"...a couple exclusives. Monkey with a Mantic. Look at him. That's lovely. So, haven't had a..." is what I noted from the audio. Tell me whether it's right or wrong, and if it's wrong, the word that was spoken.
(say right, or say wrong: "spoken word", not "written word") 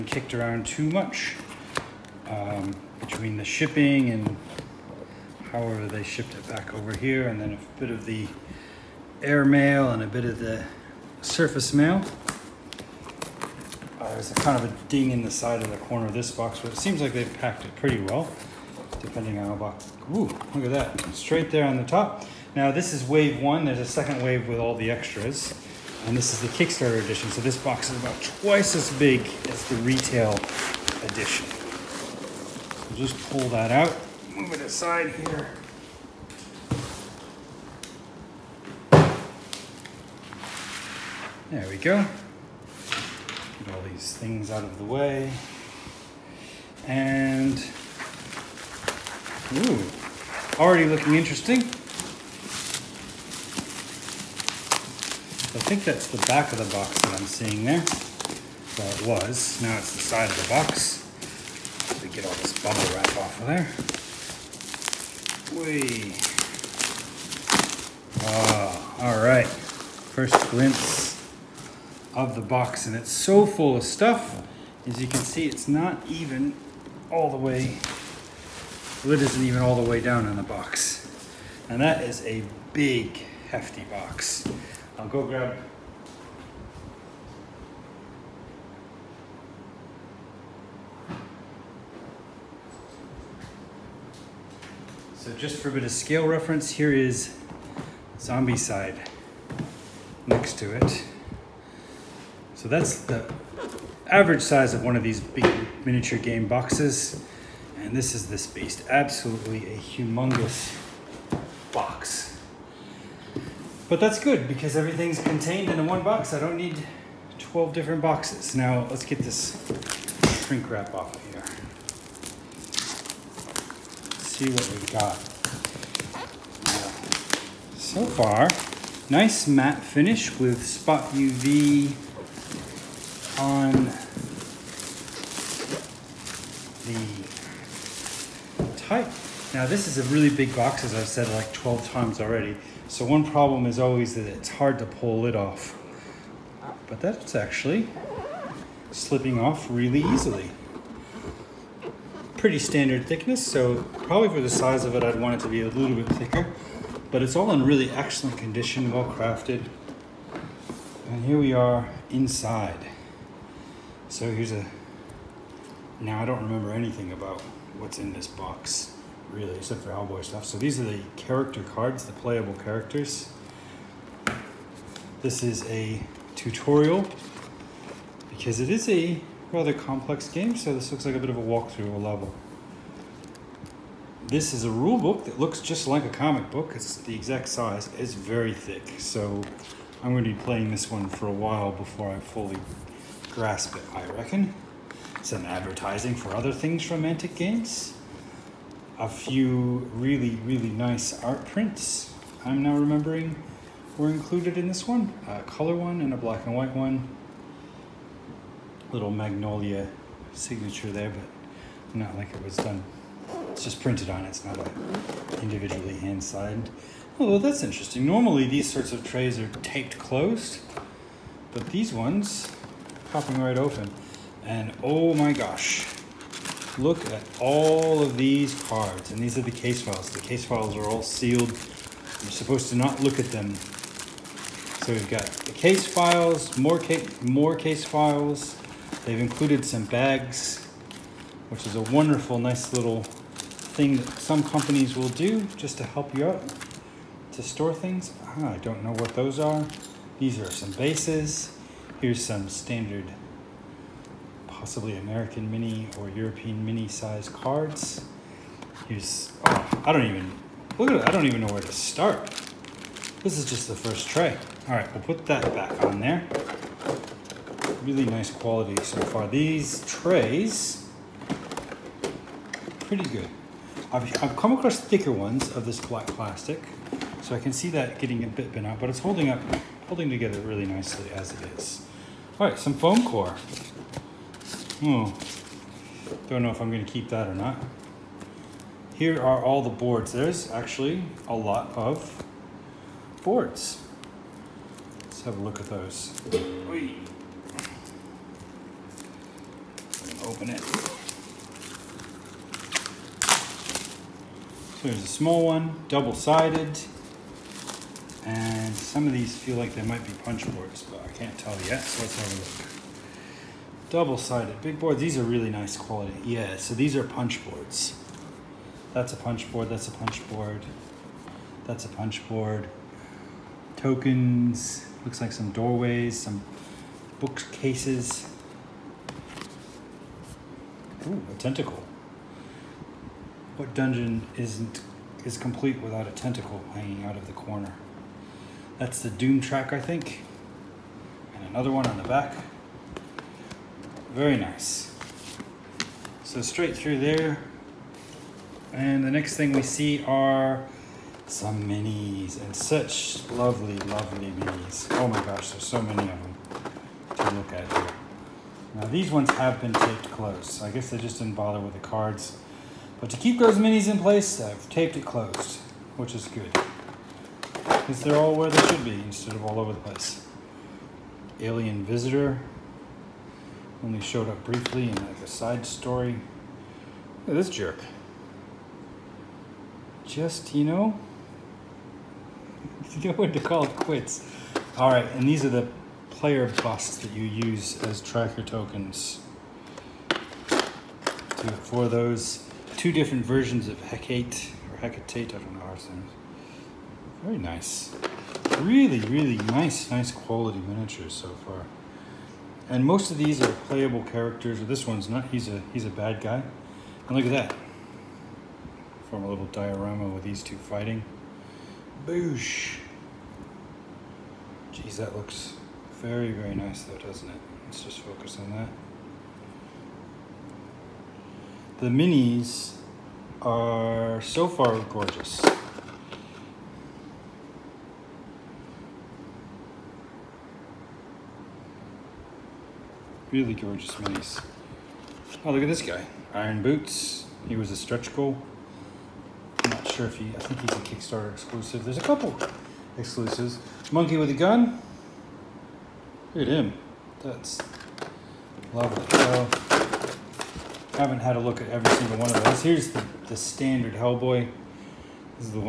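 wrong: "Gun", not "Mantic".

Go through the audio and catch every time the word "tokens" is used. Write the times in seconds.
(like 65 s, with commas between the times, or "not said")
323 s, 388 s.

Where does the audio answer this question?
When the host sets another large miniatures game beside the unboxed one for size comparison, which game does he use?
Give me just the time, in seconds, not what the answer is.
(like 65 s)
98 s.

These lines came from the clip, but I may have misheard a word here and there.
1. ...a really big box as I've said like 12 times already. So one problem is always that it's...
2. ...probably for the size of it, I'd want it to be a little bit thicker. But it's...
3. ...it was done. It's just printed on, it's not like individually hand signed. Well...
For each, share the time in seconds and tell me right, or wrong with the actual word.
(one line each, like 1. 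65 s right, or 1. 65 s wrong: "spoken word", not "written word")
1. 139 s right
2. 154 s right
3. 212 s right.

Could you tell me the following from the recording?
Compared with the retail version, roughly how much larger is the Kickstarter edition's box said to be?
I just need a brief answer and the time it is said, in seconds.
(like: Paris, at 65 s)
twice as big, at 28 s.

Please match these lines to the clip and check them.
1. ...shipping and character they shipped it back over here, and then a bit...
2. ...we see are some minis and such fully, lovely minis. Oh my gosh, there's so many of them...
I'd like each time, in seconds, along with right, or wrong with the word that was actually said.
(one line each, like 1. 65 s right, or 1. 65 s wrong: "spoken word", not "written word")
1. 3 s wrong: "however", not "character"
2. 349 s wrong: "lovely", not "fully".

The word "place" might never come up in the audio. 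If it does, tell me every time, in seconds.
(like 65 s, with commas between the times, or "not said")
364 s, 369 s.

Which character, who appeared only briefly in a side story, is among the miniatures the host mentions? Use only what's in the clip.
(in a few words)
Alien Visitor.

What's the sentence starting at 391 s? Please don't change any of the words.
for those two different versions of Hecate, or Hecate, I don't know how it's named.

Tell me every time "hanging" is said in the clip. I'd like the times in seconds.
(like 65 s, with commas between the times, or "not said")
336 s.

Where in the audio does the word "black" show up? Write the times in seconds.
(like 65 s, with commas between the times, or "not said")
206 s, 275 s.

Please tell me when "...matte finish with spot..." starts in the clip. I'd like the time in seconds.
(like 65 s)
129 s.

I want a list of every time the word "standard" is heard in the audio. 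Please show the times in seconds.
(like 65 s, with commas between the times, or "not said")
152 s, 252 s, 453 s.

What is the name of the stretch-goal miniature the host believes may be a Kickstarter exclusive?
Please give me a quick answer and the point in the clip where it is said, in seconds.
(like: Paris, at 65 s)
Iron Boots, at 436 s.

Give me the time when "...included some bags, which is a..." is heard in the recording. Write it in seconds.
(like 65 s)
239 s.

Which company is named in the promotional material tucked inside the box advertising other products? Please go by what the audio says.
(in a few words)
Mantic Games.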